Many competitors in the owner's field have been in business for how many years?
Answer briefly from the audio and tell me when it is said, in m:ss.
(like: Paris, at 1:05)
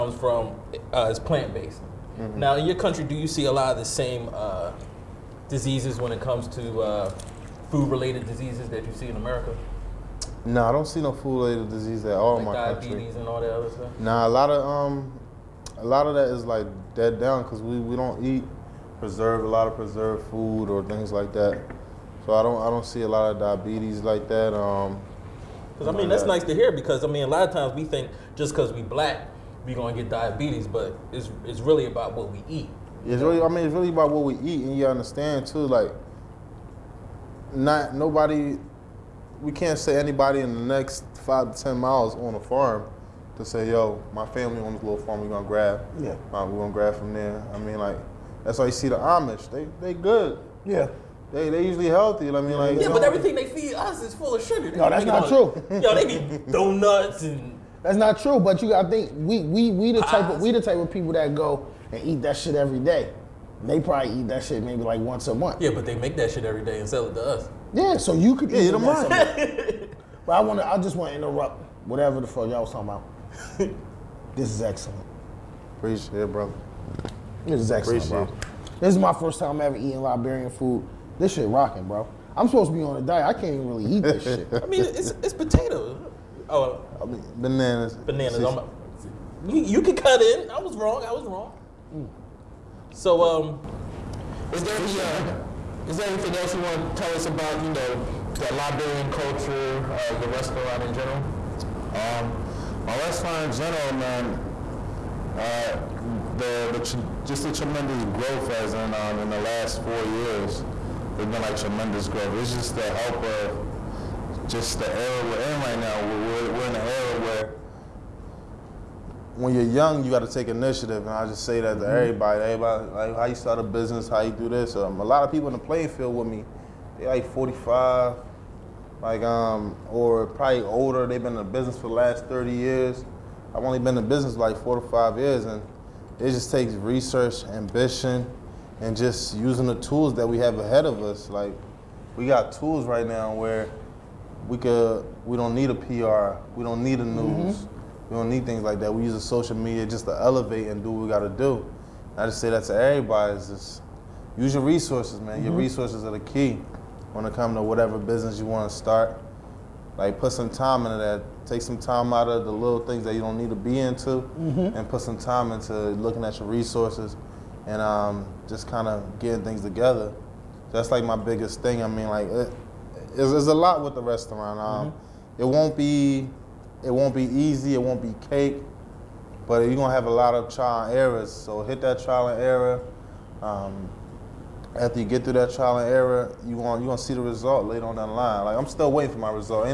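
30, at 2:12.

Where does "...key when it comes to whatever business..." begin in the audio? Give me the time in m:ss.
2:36.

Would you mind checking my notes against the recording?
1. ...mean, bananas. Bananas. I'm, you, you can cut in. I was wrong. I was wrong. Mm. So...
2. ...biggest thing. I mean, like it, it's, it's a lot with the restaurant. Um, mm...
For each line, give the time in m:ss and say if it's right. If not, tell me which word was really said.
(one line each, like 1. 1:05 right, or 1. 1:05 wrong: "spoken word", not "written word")
1. 1:27 right
2. 2:51 right.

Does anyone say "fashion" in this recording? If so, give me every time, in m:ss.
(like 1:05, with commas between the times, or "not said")
not said.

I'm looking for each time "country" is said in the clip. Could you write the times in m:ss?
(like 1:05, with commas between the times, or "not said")
0:02, 0:12.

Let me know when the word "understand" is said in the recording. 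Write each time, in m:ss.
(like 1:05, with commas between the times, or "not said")
0:34.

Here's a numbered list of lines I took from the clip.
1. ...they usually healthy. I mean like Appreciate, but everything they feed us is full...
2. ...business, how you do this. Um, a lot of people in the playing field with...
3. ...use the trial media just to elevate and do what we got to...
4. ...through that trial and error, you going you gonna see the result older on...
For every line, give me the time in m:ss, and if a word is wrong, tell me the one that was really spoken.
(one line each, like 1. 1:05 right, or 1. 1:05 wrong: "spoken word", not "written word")
1. 0:51 wrong: "Yeah", not "Appreciate"
2. 2:03 right
3. 2:29 wrong: "social", not "trial"
4. 3:05 wrong: "later", not "older".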